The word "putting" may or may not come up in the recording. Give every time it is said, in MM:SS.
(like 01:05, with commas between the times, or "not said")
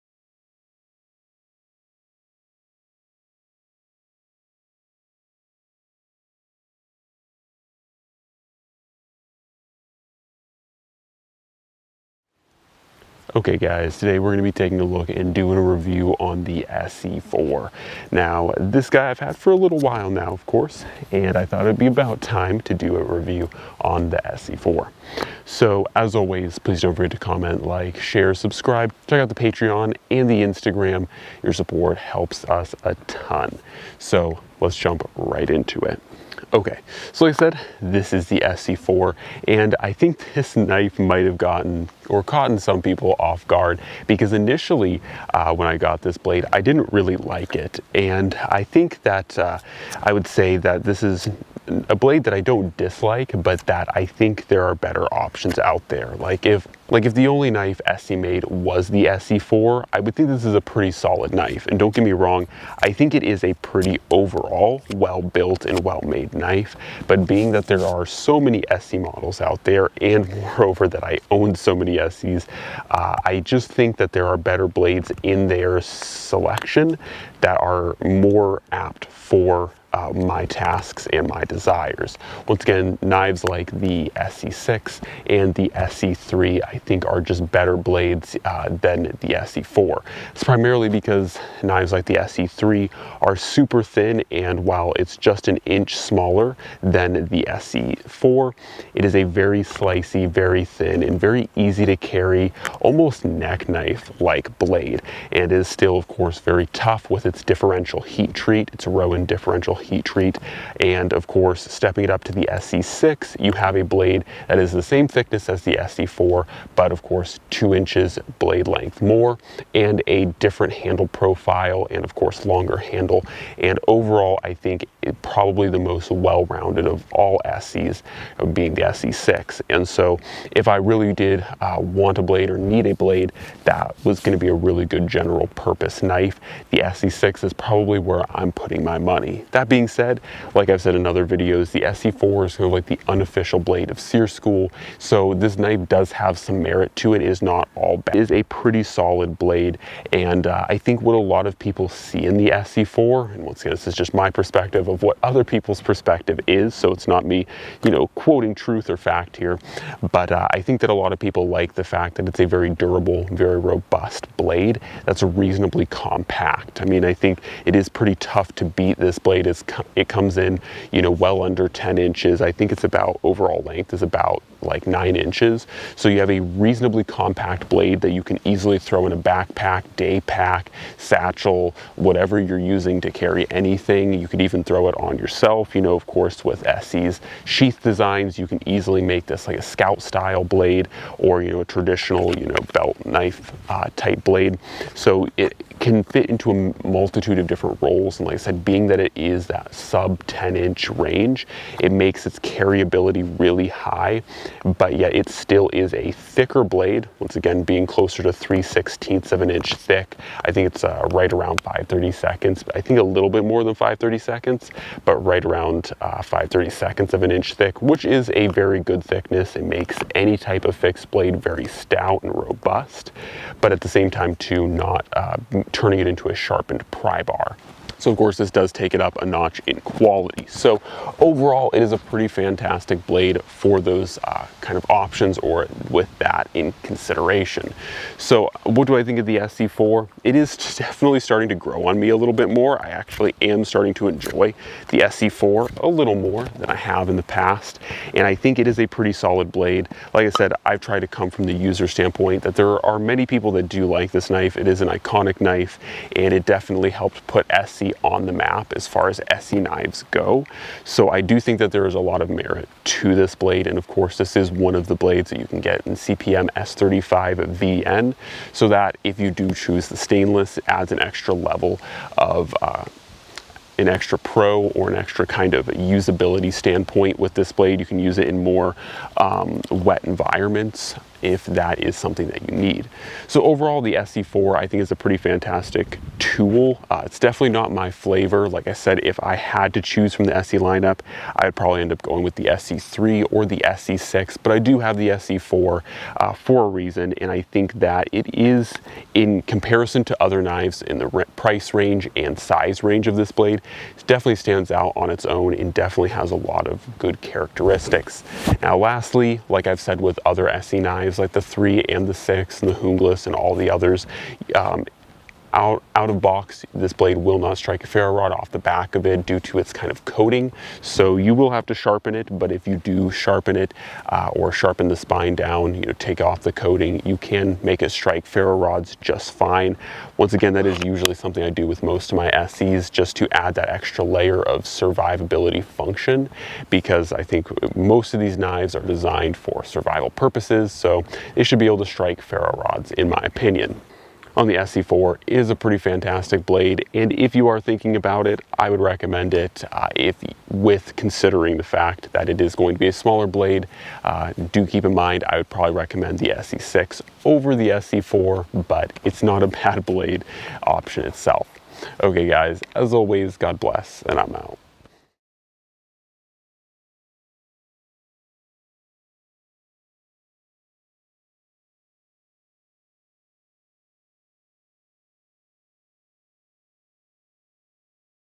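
02:18.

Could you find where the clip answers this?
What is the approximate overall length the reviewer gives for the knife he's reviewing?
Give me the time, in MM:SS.
02:54.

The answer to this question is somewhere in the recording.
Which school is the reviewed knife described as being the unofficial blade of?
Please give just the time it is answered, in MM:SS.
02:24.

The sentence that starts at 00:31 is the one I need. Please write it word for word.
Your support helps us a ton.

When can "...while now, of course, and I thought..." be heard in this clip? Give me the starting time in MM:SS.
00:19.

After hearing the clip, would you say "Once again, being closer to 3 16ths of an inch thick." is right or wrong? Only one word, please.
right.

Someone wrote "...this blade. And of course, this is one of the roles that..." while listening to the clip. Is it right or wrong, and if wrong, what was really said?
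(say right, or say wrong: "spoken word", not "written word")
wrong: "blades", not "roles".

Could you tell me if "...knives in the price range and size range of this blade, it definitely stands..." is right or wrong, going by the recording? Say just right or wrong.
right.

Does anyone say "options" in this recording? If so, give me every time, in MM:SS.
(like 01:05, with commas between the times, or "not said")
00:55, 03:54, 06:00.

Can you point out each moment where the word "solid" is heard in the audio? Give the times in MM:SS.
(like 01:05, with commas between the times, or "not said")
01:00, 02:28, 04:09.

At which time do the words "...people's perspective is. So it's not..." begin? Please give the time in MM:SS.
02:35.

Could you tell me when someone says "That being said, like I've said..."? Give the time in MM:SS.
02:19.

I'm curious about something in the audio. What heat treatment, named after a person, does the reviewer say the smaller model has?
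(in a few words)
Rowen differential heat treat.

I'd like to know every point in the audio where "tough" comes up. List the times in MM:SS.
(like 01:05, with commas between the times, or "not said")
01:46, 02:48.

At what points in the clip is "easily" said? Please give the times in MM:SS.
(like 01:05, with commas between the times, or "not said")
02:58, 03:08.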